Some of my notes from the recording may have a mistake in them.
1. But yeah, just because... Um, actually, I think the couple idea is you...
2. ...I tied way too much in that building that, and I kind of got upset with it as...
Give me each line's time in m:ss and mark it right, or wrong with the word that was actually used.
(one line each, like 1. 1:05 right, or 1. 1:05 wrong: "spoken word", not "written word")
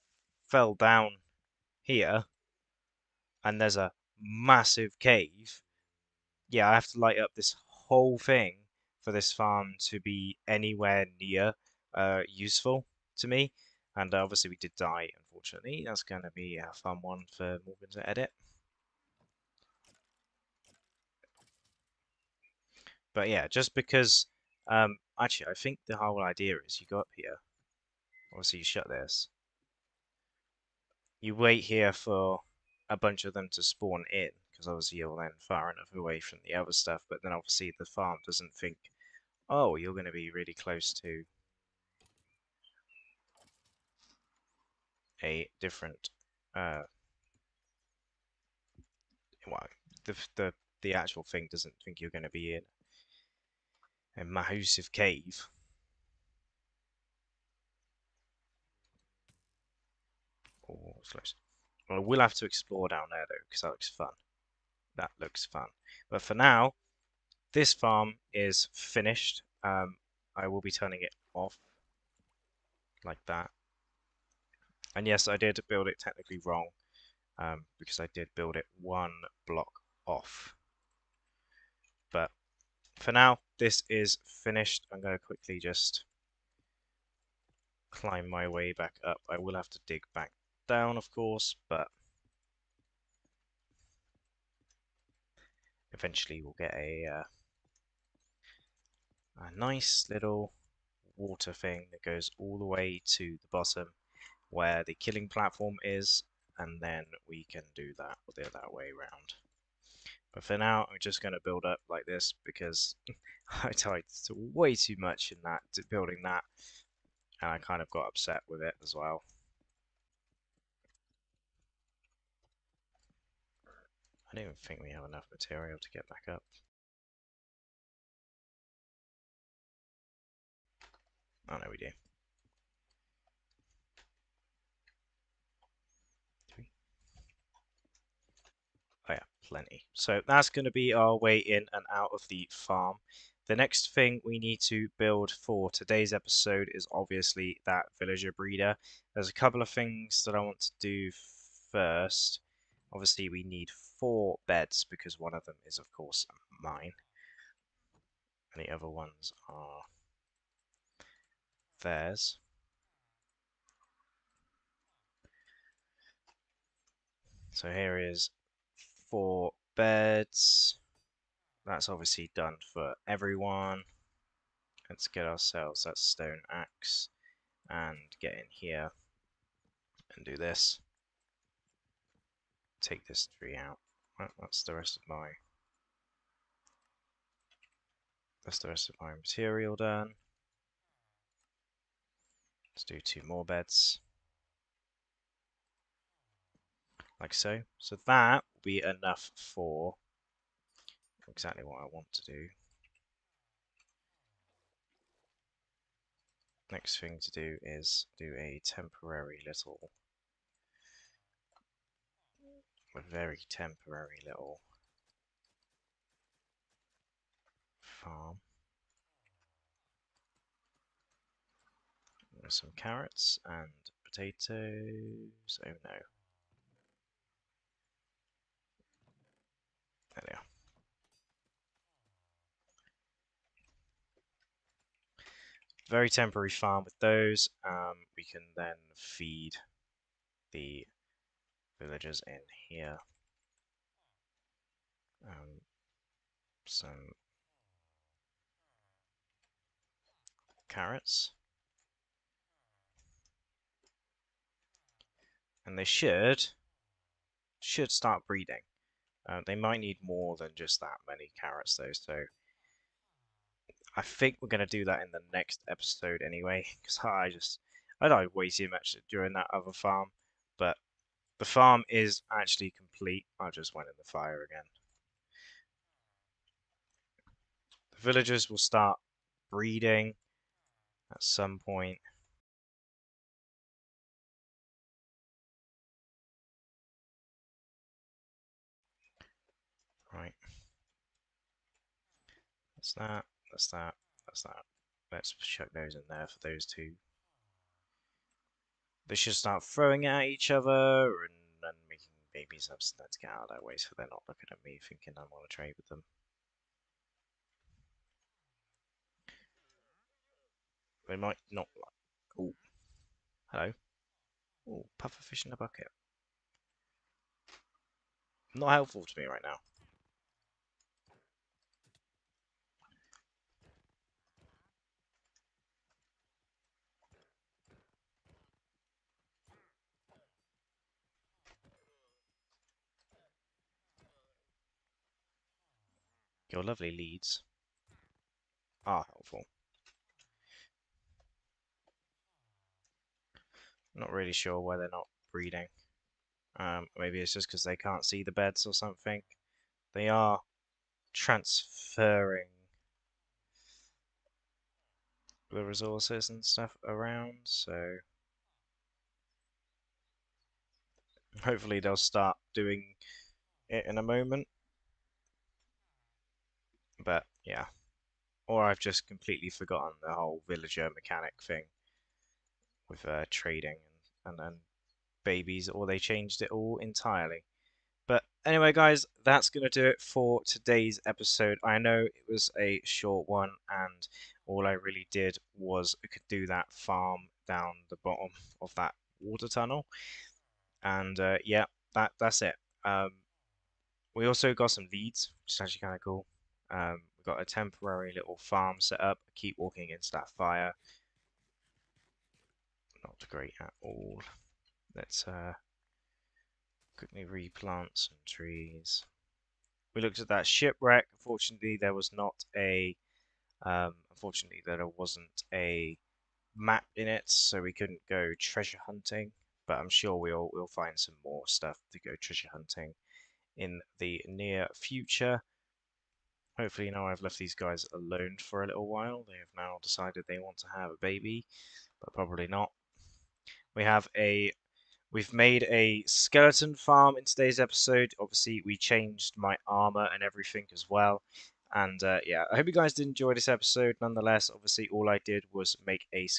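1. 0:23 wrong: "whole", not "couple"
2. 1:53 right.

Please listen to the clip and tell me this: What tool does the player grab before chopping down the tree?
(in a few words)
Stone axe.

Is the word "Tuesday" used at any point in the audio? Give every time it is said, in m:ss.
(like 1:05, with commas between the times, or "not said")
not said.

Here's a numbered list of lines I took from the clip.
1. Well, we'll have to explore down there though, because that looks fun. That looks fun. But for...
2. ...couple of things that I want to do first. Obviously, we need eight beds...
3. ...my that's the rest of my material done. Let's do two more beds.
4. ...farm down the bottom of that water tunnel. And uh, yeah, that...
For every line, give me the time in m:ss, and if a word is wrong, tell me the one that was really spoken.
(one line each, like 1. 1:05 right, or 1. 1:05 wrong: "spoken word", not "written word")
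1. 1:01 right
2. 2:29 wrong: "four", not "eight"
3. 3:05 right
4. 6:26 right.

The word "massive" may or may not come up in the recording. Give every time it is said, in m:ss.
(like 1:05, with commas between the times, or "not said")
0:04, 0:54.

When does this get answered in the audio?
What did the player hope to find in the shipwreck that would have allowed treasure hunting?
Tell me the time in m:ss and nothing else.
6:56.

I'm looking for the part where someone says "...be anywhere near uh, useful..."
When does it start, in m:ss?
0:09.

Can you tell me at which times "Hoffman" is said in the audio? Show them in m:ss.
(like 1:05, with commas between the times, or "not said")
not said.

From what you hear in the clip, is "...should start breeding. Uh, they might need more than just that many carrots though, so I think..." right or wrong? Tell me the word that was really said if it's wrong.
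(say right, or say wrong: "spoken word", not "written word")
right.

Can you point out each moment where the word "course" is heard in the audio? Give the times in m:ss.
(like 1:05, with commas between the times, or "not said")
1:31, 2:35.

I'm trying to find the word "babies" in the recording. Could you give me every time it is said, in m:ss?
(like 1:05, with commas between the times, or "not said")
5:02, 6:15.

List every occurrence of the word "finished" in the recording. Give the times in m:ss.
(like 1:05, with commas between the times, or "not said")
1:08, 1:24.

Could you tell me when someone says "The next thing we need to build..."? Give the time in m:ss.
2:23.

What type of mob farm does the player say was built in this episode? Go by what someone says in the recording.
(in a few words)
Skeleton farm.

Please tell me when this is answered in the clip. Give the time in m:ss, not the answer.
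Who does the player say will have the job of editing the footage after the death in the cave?
0:17.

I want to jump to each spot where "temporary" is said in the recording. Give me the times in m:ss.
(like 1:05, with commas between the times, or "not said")
3:28, 3:33, 3:56, 6:37.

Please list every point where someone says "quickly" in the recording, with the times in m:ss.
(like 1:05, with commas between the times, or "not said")
1:25, 6:46.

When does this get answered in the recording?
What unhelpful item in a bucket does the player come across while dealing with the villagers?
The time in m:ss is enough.
5:14.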